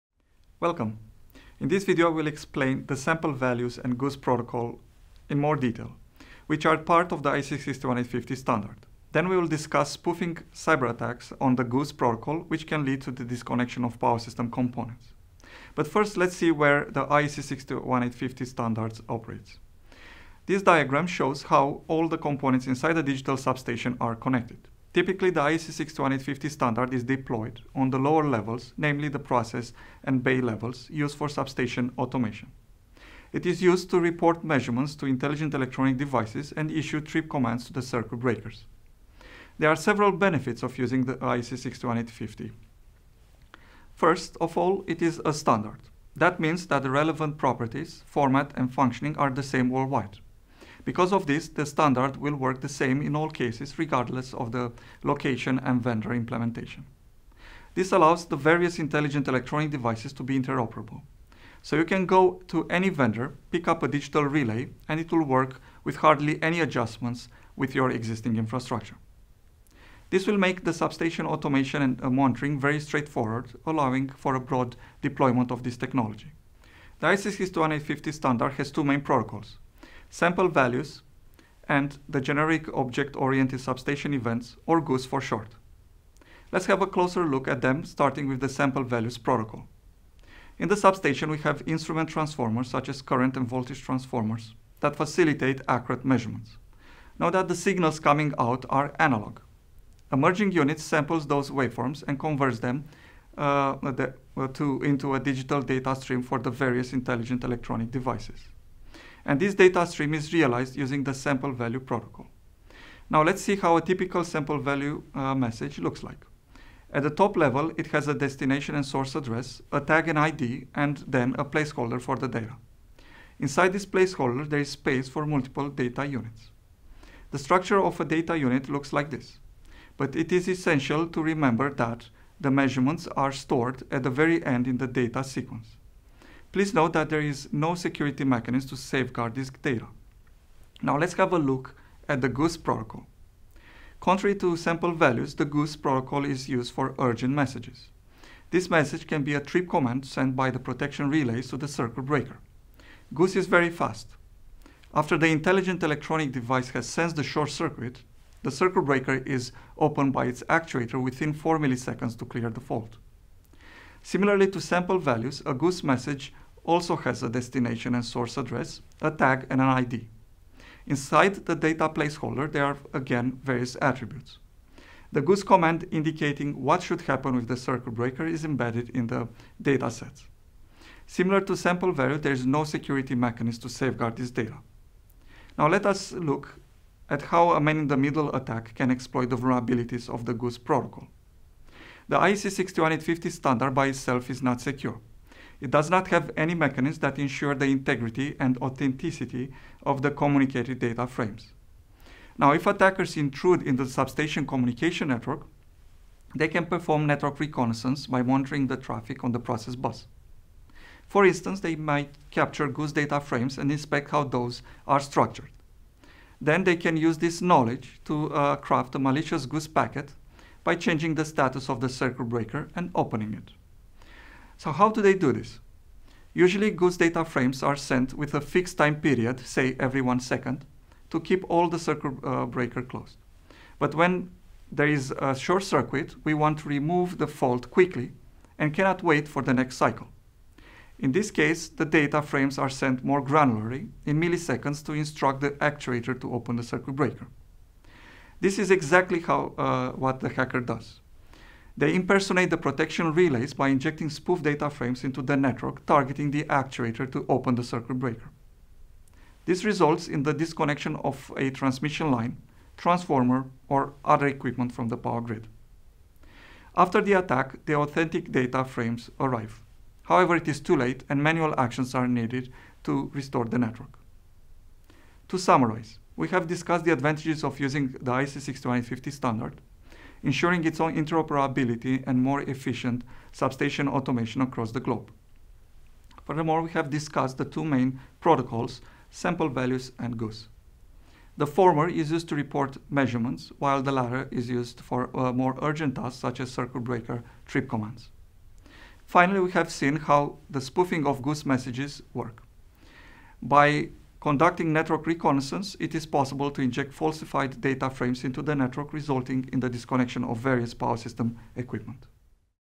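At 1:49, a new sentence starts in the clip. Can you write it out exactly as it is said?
And this data stream is realized using the sample value protocol.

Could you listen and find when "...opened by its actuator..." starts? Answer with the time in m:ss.
2:39.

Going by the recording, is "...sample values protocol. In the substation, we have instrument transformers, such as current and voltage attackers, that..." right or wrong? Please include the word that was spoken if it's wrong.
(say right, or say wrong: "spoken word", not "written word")
wrong: "transformers", not "attackers".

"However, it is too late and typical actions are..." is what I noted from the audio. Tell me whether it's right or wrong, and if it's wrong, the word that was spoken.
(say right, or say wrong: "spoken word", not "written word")
wrong: "manual", not "typical".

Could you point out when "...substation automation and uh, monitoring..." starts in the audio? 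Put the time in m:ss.
1:10.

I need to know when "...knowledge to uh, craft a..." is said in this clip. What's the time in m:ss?
3:37.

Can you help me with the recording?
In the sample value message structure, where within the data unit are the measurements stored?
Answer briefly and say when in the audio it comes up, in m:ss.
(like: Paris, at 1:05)
at the very end, at 2:13.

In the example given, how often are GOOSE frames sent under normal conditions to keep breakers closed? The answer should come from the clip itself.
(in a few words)
every one second.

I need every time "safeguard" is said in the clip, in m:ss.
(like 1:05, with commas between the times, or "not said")
2:18, 3:03.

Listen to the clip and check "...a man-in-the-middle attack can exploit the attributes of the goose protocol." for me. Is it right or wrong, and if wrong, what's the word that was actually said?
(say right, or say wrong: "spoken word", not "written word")
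wrong: "vulnerabilities", not "attributes".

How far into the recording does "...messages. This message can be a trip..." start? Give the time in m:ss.
2:27.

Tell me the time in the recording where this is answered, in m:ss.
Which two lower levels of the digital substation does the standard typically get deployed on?
0:29.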